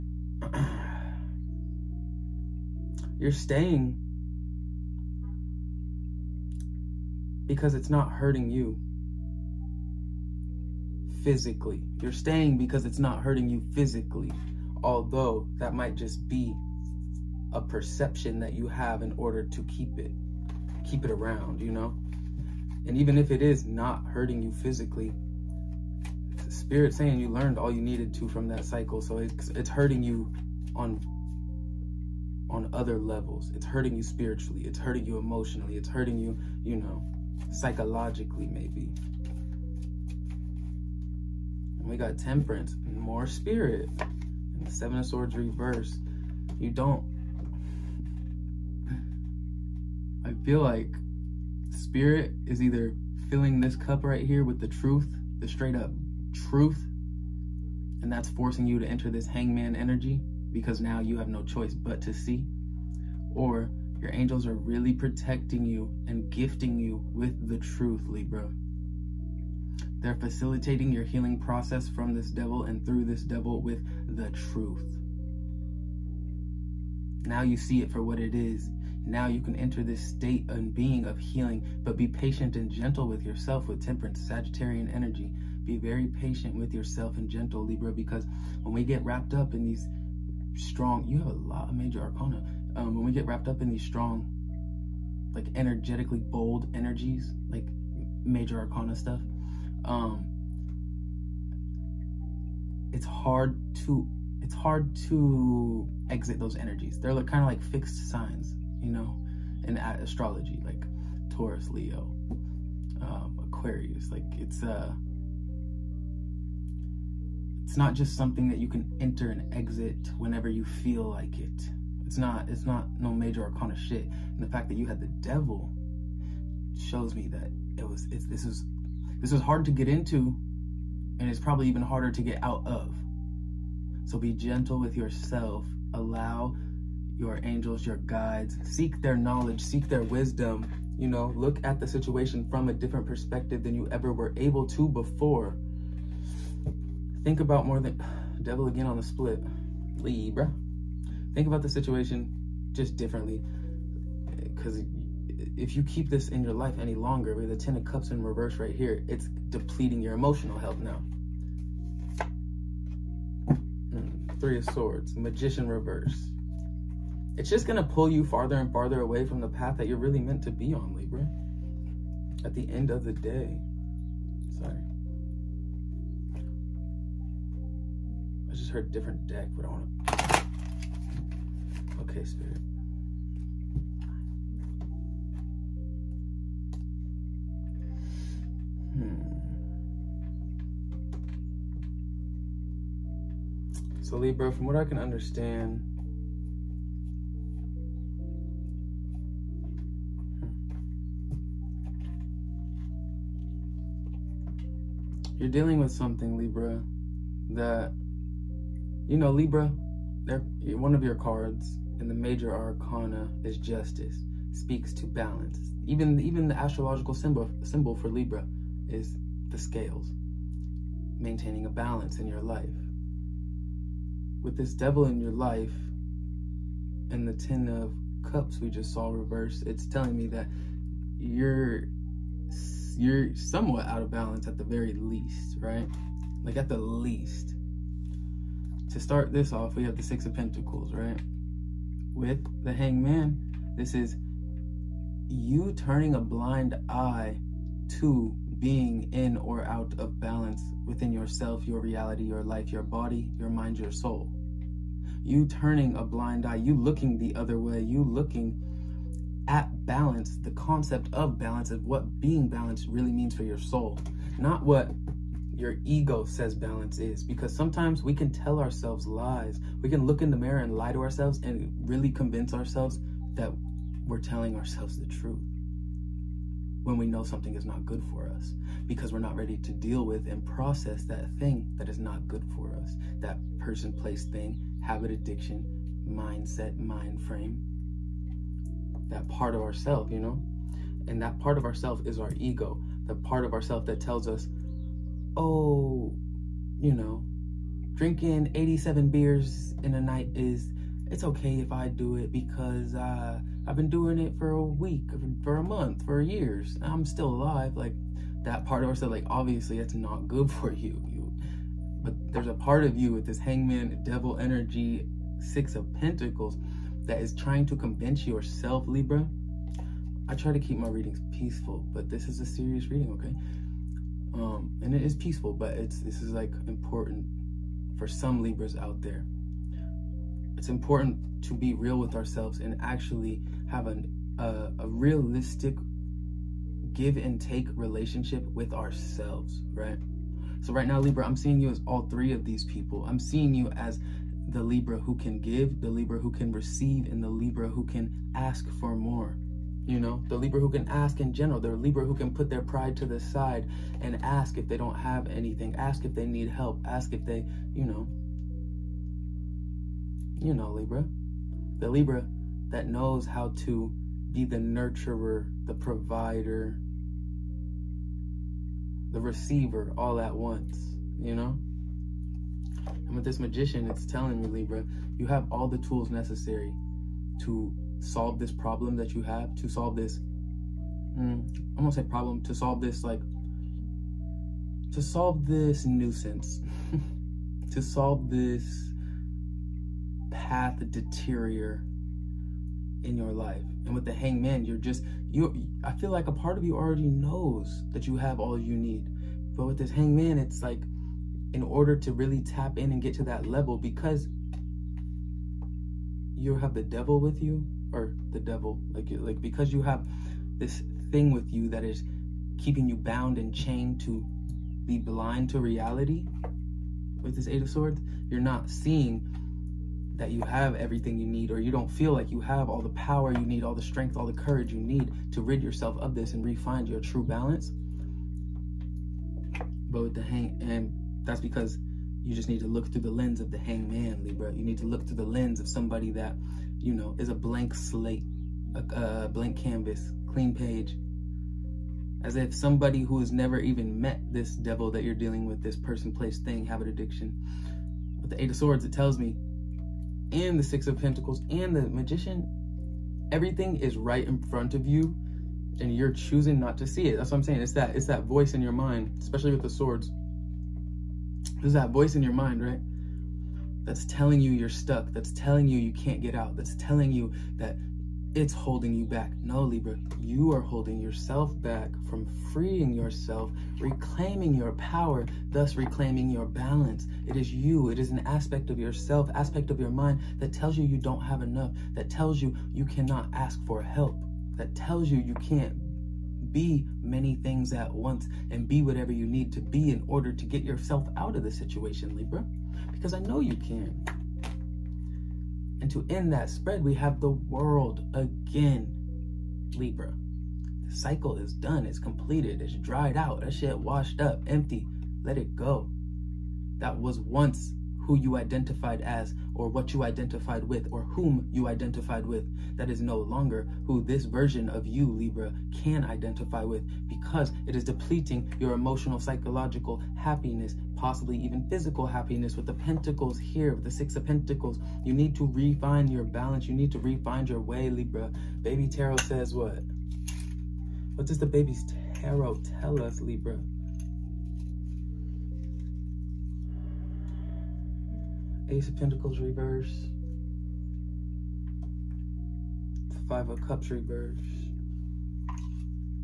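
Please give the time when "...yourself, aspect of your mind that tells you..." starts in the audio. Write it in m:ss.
7:58.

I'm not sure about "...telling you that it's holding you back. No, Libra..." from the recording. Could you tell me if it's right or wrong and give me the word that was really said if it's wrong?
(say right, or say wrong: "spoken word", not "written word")
right.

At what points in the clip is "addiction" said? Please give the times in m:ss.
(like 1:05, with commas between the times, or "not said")
4:45, 7:26.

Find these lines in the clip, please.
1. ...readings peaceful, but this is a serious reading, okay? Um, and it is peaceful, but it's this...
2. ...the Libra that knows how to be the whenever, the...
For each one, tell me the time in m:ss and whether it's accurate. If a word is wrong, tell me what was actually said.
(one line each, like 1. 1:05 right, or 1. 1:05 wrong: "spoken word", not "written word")
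1. 5:20 right
2. 6:01 wrong: "nurturer", not "whenever".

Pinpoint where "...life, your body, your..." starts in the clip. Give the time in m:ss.
4:12.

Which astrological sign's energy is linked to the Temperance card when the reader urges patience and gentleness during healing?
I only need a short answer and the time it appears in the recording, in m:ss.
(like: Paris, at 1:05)
Sagittarian, at 1:24.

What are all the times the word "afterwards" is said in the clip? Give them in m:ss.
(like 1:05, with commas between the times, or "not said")
not said.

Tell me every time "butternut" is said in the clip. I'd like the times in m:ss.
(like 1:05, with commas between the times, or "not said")
not said.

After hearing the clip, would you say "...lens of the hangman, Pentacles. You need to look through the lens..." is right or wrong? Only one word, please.
wrong.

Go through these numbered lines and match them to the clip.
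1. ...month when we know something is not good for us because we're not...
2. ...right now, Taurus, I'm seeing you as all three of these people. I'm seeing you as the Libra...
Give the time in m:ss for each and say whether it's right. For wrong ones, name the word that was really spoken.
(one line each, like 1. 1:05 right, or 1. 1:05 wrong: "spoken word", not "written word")
1. 4:35 wrong: "truth", not "month"
2. 5:40 wrong: "Libra", not "Taurus".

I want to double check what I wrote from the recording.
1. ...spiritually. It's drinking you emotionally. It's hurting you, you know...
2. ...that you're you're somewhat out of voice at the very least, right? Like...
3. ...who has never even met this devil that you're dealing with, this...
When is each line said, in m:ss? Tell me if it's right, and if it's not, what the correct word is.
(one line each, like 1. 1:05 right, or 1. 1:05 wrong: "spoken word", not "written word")
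1. 0:34 wrong: "hurting", not "drinking"
2. 3:50 wrong: "balance", not "voice"
3. 7:23 right.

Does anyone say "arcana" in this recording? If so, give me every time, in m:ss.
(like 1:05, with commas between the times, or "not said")
1:32, 1:38, 2:03, 3:32.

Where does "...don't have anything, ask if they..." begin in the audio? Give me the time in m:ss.
5:54.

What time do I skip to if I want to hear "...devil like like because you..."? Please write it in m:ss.
6:48.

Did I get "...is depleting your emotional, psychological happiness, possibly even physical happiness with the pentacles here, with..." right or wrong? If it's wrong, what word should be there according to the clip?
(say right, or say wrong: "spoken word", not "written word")
right.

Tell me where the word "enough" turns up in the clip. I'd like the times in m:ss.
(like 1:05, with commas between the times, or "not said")
8:01.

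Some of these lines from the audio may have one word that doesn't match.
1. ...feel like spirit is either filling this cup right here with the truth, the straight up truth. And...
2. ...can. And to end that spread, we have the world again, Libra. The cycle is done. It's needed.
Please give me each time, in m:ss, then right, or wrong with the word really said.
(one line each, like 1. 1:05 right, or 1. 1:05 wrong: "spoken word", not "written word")
1. 0:50 right
2. 8:13 wrong: "completed", not "needed".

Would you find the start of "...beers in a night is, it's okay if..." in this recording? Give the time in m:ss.
4:59.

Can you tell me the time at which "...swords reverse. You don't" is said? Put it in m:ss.
0:45.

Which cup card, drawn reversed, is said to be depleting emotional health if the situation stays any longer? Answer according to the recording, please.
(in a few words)
Ten of Cups.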